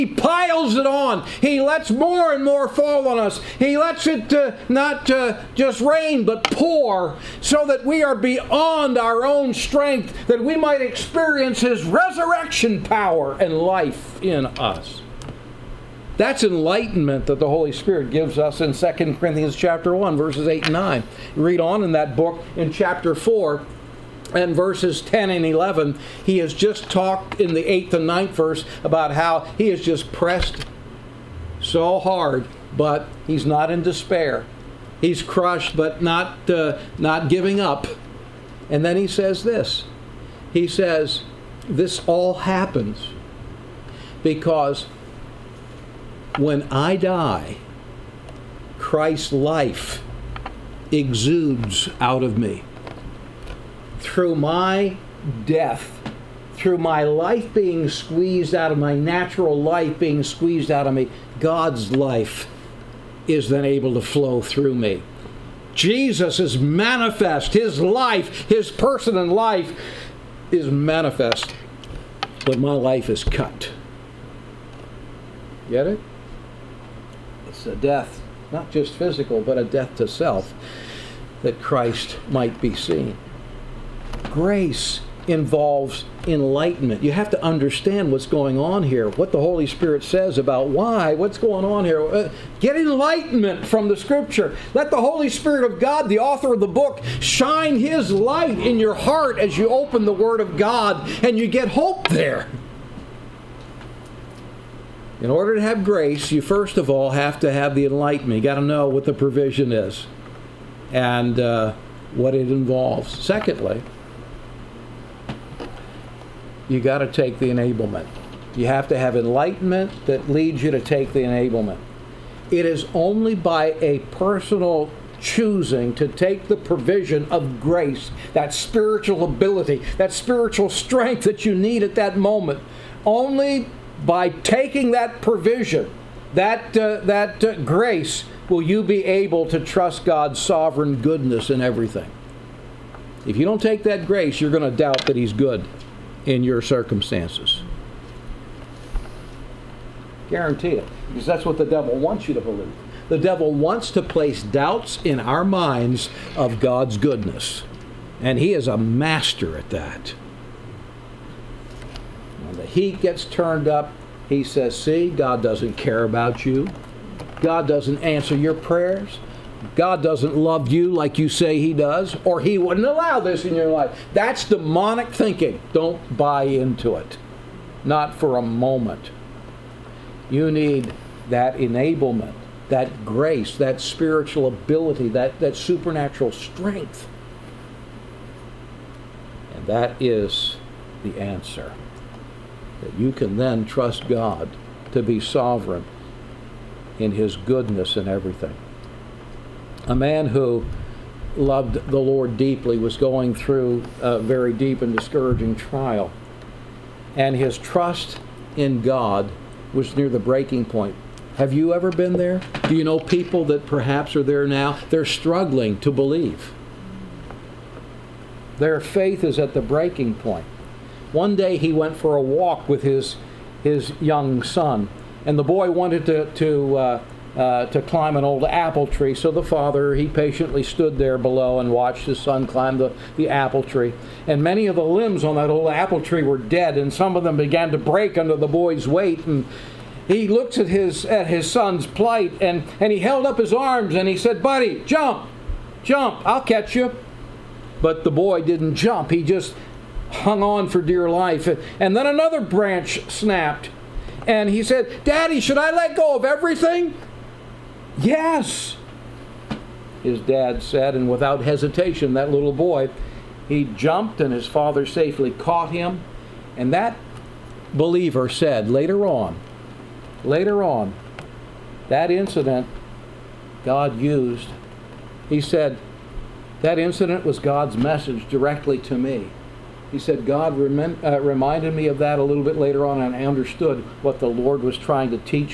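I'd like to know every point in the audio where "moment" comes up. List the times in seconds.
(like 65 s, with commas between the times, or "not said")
132 s, 178 s.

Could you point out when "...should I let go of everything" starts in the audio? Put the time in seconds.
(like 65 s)
255 s.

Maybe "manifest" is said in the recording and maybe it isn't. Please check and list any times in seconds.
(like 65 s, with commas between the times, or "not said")
66 s, 70 s.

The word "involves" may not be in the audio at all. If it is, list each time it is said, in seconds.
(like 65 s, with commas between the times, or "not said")
85 s, 112 s.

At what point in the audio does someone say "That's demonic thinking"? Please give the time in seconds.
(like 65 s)
174 s.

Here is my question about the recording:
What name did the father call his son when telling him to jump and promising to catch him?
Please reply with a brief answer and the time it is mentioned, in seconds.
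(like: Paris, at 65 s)
Buddy, at 244 s.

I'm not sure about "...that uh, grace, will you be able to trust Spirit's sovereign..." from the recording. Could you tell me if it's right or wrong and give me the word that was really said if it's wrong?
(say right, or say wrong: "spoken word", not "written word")
wrong: "God", not "Spirit".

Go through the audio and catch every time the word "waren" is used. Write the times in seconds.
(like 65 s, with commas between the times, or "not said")
not said.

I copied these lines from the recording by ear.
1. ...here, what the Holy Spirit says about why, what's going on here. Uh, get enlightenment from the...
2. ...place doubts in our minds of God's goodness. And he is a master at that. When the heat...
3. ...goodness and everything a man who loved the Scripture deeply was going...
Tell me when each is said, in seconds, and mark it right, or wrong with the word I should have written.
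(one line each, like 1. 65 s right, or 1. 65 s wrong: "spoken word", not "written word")
1. 88 s right
2. 154 s right
3. 197 s wrong: "Lord", not "Scripture".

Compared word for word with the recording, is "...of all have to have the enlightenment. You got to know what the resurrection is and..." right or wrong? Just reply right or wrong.
wrong.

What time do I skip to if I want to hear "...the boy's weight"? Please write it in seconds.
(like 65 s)
238 s.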